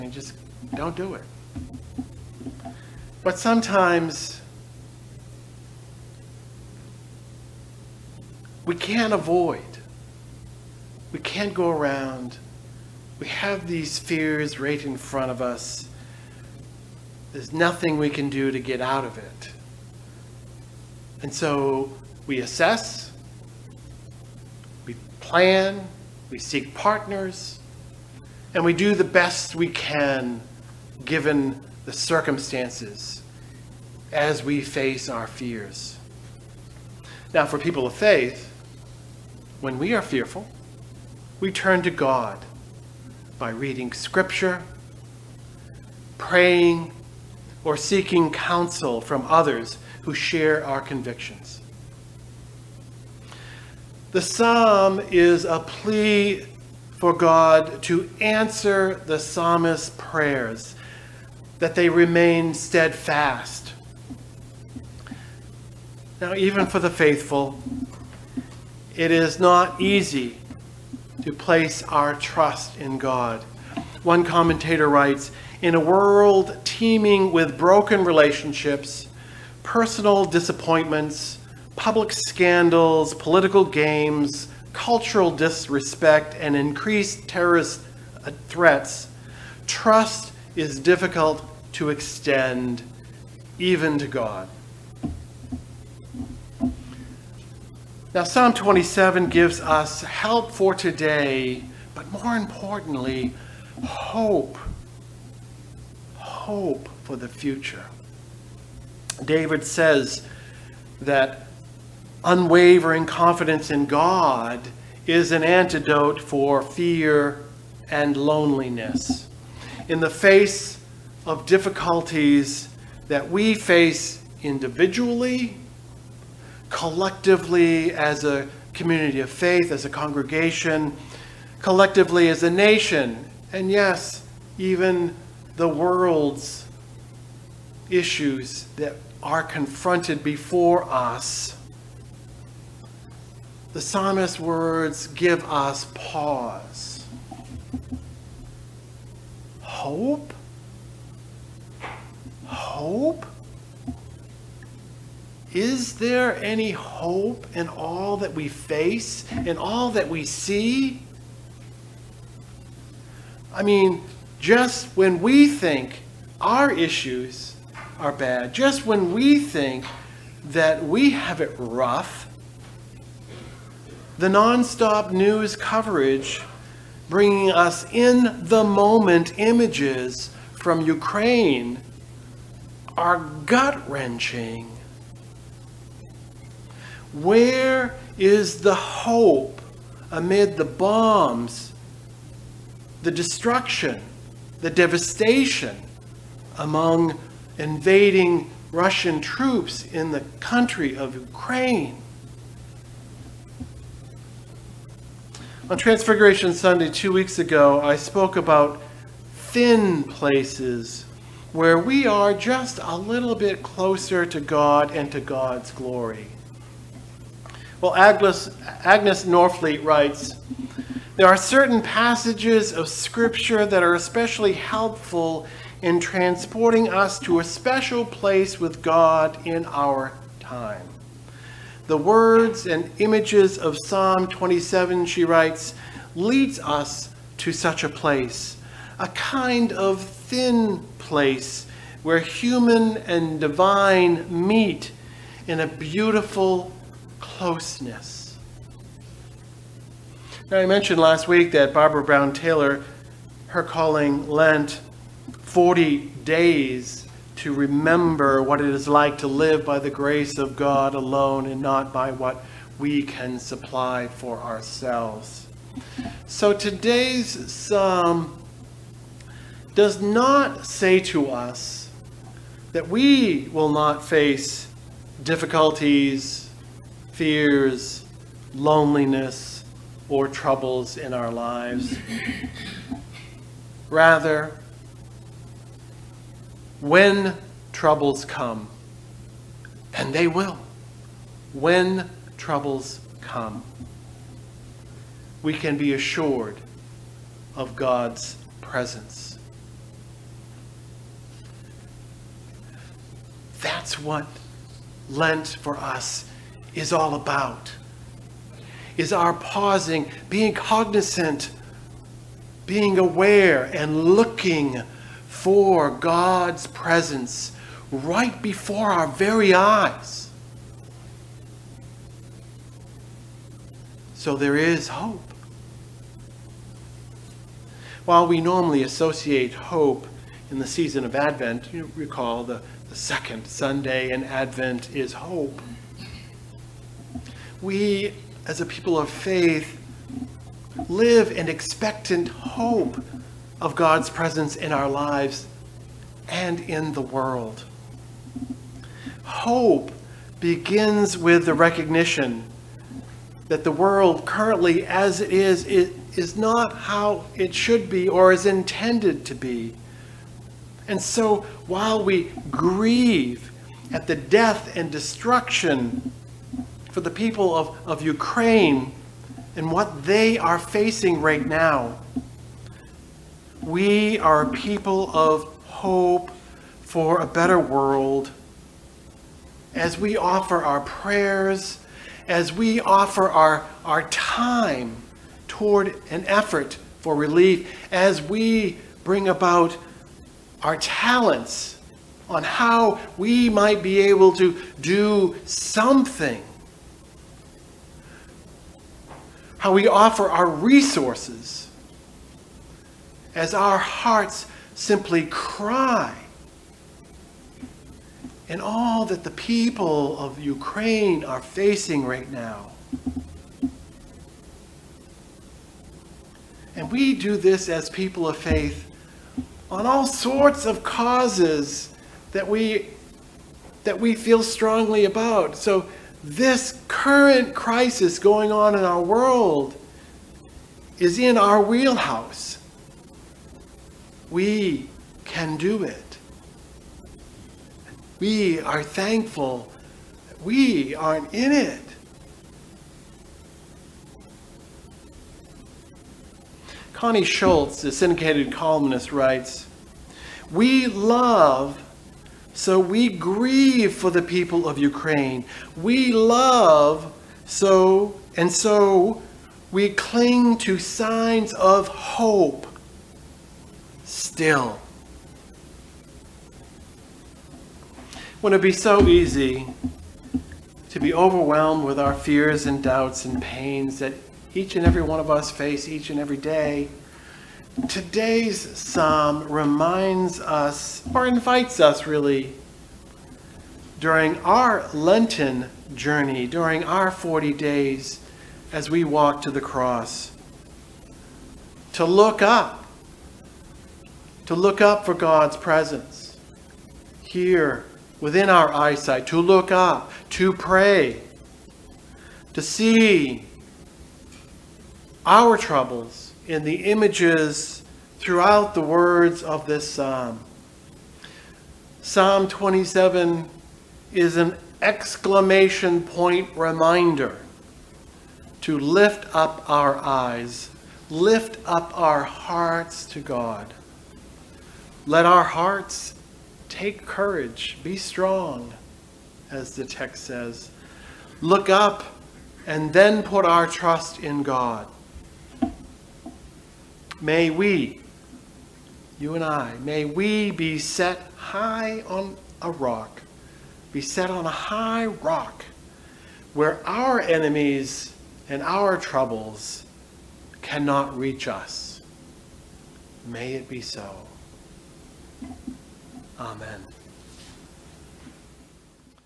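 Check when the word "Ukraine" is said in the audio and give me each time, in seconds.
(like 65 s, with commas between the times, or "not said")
180 s, 201 s, 368 s, 410 s, 454 s.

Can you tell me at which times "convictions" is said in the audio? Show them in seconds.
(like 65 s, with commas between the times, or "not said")
50 s.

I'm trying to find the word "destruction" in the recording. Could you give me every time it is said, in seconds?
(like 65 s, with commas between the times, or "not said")
193 s, 364 s.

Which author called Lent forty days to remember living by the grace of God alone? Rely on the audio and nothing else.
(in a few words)
Barbara Brown Taylor.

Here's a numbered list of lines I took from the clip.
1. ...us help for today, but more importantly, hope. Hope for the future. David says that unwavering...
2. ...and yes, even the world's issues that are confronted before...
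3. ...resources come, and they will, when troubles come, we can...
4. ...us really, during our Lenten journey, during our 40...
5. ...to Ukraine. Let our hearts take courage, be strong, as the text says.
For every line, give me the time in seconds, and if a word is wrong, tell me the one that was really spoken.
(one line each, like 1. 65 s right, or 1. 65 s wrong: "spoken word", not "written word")
1. 99 s right
2. 133 s right
3. 287 s wrong: "troubles", not "resources"
4. 481 s right
5. 523 s wrong: "God", not "Ukraine".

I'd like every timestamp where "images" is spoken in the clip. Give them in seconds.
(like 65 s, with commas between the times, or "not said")
179 s, 232 s, 506 s.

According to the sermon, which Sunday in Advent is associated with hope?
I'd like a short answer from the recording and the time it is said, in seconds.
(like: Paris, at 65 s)
second, at 332 s.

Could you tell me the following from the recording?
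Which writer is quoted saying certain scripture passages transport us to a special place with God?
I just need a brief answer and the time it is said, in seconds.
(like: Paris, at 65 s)
Agnes Norfleet, at 218 s.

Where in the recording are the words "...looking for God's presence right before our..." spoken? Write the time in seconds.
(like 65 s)
314 s.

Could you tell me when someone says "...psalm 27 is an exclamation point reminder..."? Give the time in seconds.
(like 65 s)
512 s.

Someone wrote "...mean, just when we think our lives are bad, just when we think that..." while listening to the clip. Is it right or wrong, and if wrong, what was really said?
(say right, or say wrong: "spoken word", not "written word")
wrong: "issues", not "lives".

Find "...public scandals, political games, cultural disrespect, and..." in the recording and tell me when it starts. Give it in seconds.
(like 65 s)
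81 s.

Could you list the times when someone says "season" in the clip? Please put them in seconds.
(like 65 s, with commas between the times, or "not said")
330 s.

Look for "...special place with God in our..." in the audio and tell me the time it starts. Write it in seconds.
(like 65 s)
227 s.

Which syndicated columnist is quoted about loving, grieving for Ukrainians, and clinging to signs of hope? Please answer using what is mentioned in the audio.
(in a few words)
Connie Schultz.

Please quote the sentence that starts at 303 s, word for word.
That's what Lent for us is all about.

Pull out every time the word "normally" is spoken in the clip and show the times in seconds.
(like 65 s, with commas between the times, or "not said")
328 s.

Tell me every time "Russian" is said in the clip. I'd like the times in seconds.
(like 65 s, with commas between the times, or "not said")
198 s.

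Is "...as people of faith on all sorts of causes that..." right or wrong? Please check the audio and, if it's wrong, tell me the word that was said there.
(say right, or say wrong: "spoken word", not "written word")
right.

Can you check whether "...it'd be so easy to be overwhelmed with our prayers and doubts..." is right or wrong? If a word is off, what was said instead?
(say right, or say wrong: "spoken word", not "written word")
wrong: "fears", not "prayers".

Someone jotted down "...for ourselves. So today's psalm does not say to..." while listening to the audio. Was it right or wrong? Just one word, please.
right.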